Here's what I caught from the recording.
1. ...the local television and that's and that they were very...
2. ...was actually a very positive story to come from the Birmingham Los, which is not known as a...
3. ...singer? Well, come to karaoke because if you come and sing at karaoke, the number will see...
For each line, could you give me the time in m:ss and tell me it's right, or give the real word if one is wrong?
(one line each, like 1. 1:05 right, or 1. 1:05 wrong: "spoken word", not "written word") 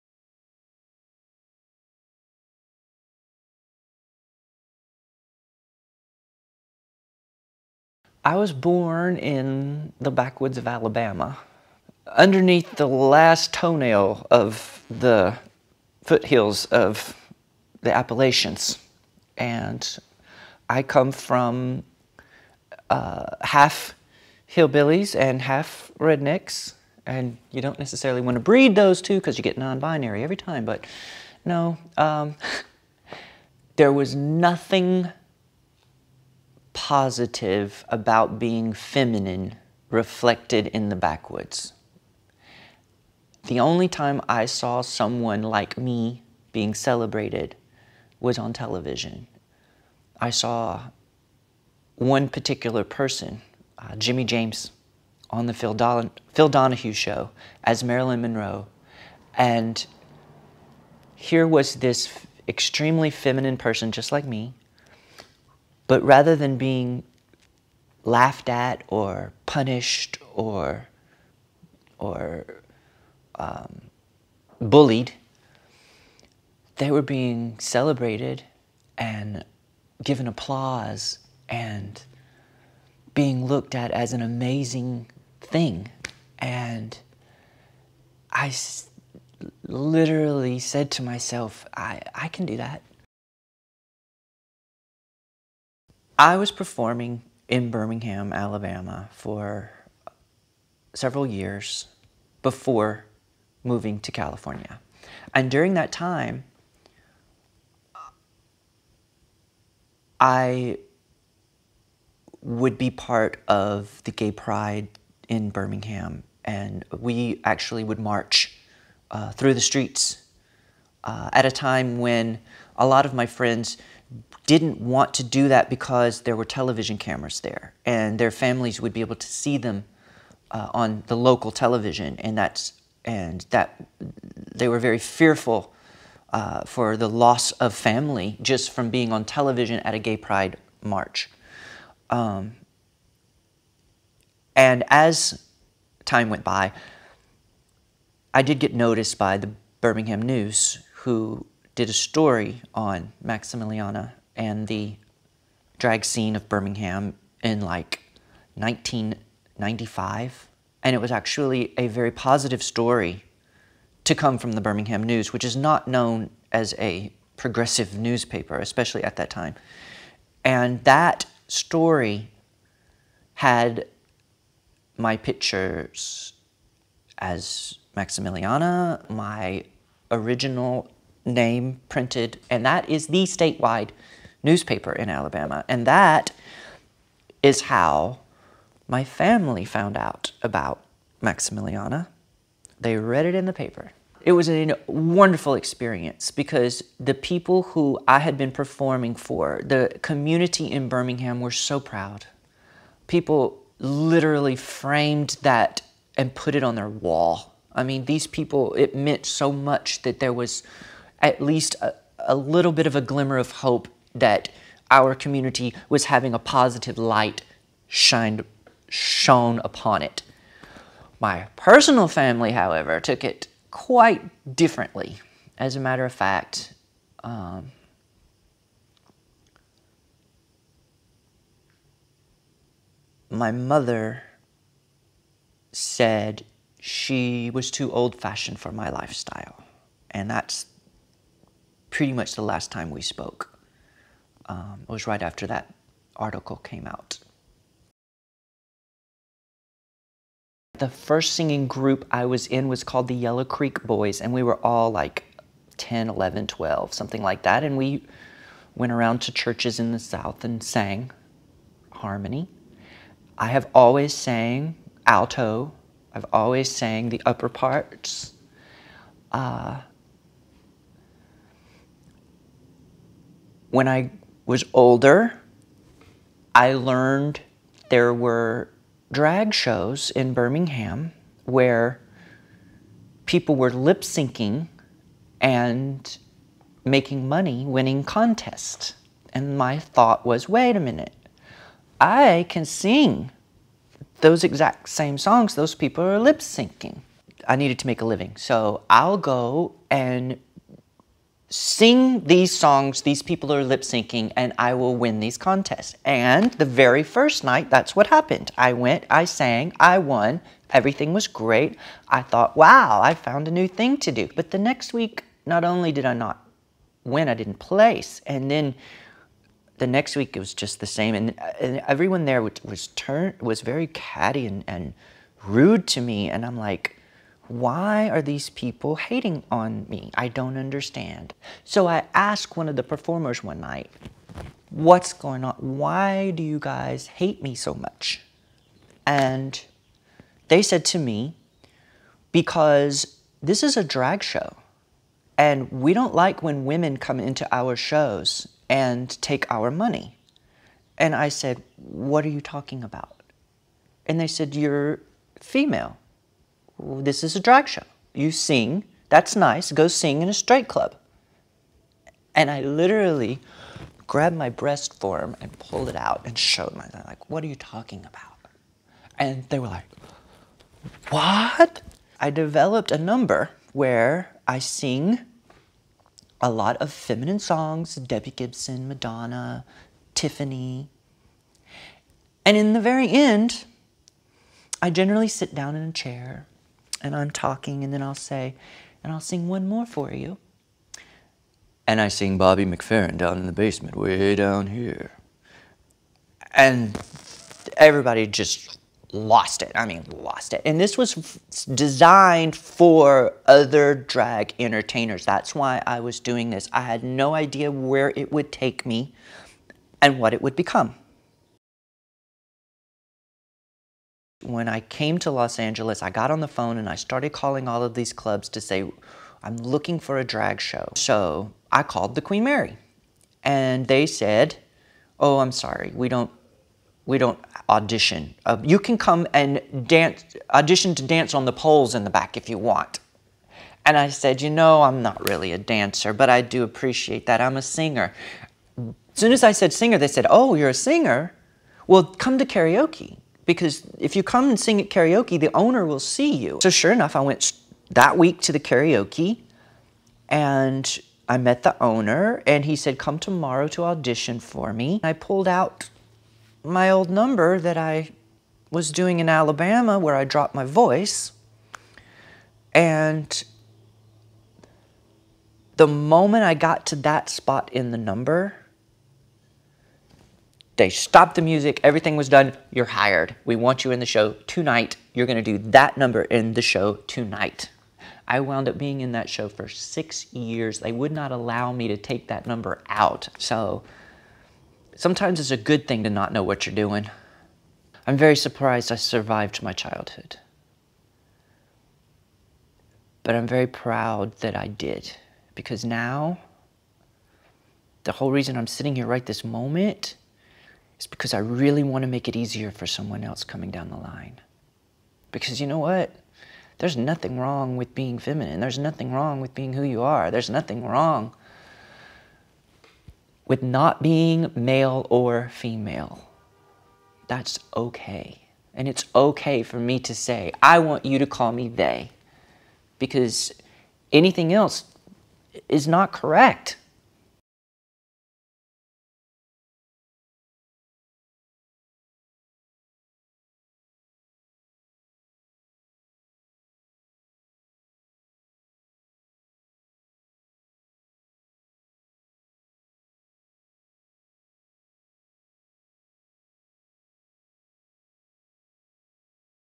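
1. 2:11 right
2. 2:40 wrong: "News", not "Los"
3. 7:20 wrong: "owner", not "number".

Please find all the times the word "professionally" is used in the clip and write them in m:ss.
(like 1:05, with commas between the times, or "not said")
not said.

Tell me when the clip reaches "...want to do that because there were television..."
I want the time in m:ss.
2:04.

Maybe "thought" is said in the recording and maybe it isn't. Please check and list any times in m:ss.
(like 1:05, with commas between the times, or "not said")
4:49, 5:12.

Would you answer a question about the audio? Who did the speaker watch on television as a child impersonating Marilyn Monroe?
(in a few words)
Jimmy James.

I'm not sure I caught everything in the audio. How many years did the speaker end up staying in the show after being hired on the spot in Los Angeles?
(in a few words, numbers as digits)
6.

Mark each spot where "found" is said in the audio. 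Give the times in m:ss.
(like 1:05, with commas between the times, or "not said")
3:09, 5:13.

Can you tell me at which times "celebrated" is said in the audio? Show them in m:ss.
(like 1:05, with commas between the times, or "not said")
0:46, 1:17.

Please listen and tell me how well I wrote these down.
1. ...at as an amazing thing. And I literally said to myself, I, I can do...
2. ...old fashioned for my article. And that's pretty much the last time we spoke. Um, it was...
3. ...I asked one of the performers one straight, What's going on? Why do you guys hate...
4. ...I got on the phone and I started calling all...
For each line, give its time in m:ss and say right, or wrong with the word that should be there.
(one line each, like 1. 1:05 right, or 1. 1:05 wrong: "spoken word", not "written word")
1. 1:23 right
2. 3:57 wrong: "lifestyle", not "article"
3. 5:31 wrong: "night", not "straight"
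4. 6:56 right.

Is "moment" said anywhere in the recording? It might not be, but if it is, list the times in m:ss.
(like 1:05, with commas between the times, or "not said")
7:45, 8:19.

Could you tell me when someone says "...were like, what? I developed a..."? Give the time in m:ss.
6:09.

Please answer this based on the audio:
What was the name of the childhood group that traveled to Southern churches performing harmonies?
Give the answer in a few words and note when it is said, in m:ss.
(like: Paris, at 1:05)
Yellow Creek Boys, at 4:13.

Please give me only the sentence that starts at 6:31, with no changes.
And I sing Bobby McFerrin down in the basement, way down here.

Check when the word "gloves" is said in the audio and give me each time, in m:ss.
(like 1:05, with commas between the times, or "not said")
not said.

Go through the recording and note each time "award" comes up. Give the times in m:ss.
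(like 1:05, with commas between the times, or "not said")
not said.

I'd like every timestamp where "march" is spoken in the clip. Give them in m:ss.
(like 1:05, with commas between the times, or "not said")
1:57, 2:20.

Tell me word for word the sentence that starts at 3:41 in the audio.
My personal family, however, took it quite differently.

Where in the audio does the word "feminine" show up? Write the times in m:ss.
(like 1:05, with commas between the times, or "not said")
0:38, 1:03, 6:16, 8:28.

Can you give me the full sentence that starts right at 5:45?
And we don't like when women come into our shows and take our money.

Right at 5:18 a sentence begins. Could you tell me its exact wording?
And then the next week, it was just the same.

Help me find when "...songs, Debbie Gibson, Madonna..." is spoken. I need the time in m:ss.
6:17.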